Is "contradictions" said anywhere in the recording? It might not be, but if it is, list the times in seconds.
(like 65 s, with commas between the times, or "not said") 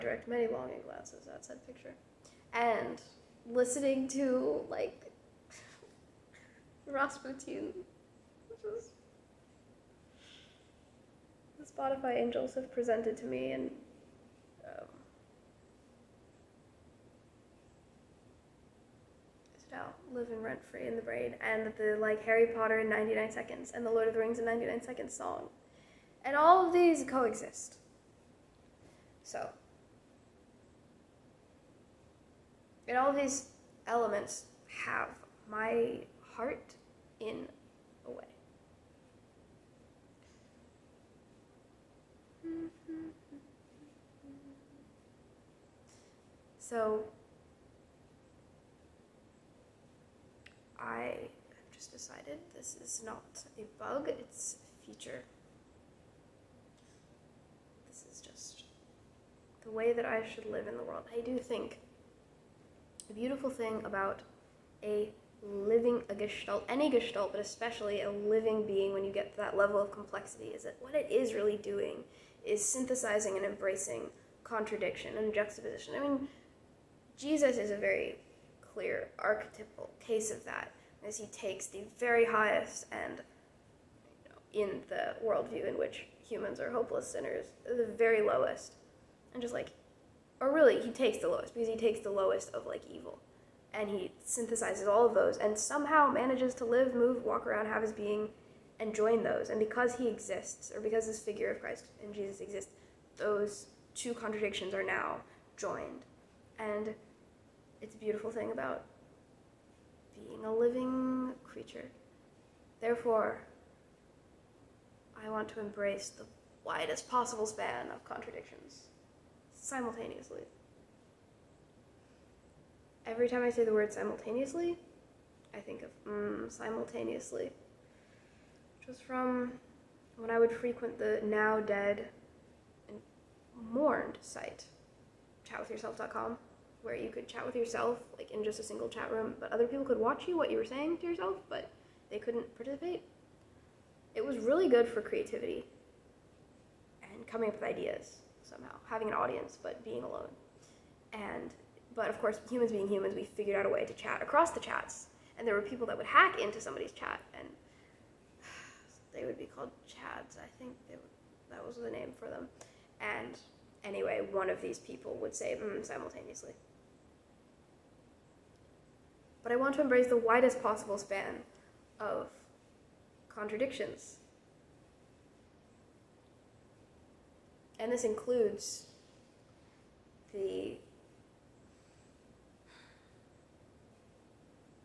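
74 s, 104 s, 118 s, 173 s.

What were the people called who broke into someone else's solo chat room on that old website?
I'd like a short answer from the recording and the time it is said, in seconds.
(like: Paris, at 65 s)
chads, at 159 s.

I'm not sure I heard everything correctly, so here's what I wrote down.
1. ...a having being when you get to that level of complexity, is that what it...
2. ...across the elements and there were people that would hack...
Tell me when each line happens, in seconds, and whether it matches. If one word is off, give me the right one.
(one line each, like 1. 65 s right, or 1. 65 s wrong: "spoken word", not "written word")
1. 68 s wrong: "living", not "having"
2. 154 s wrong: "chats", not "elements".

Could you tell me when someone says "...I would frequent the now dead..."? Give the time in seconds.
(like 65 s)
130 s.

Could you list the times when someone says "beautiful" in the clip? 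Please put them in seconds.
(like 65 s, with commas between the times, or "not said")
63 s, 107 s.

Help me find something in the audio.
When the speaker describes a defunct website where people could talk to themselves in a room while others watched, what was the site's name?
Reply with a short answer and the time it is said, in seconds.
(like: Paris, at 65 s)
chatwithyourself.com, at 135 s.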